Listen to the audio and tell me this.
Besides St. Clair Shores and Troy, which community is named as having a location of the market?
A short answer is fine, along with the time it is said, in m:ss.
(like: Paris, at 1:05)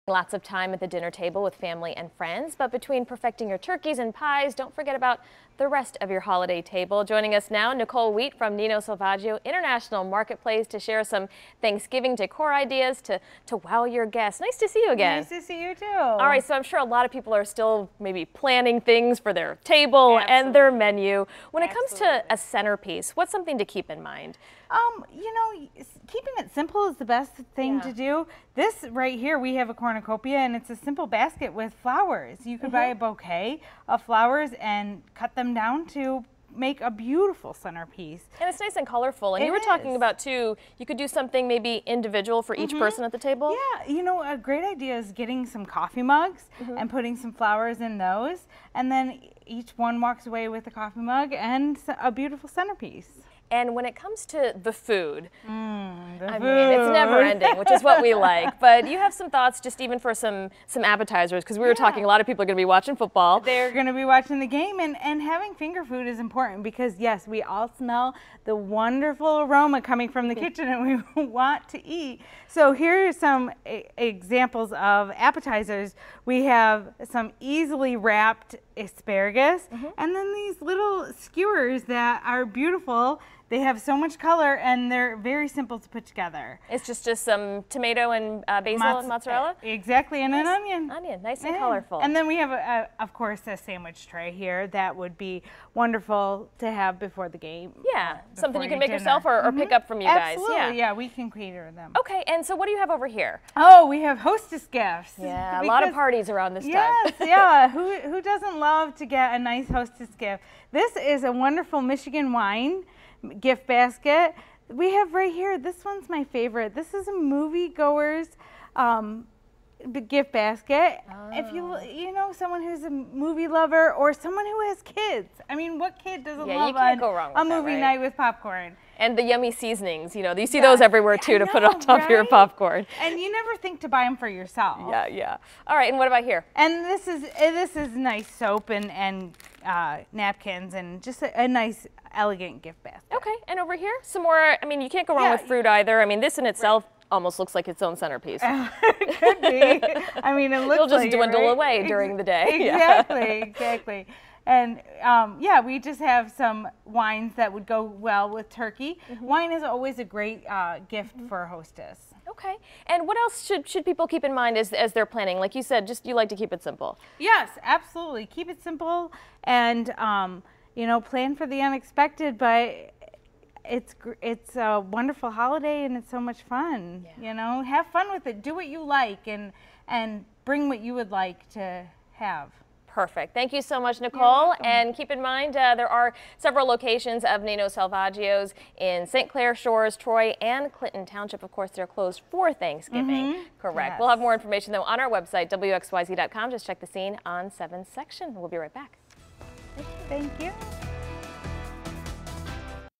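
Clinton Township, at 3:10.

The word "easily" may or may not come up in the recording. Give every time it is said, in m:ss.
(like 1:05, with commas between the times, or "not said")
1:17.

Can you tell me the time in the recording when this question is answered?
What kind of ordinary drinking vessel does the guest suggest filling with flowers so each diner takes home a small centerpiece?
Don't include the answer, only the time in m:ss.
0:45.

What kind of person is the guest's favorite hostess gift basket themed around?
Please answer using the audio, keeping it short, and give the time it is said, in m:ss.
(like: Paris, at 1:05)
Moviegoer, at 1:57.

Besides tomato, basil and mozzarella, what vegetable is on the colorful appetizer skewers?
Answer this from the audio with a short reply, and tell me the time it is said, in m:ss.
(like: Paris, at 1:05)
Onion, at 1:30.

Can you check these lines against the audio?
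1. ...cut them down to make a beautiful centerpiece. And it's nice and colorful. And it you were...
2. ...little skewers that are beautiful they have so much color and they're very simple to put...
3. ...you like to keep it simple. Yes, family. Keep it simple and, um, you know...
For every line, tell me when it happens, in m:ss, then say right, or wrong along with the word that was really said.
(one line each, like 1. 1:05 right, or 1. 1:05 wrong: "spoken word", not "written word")
1. 0:35 right
2. 1:20 right
3. 2:46 wrong: "absolutely", not "family".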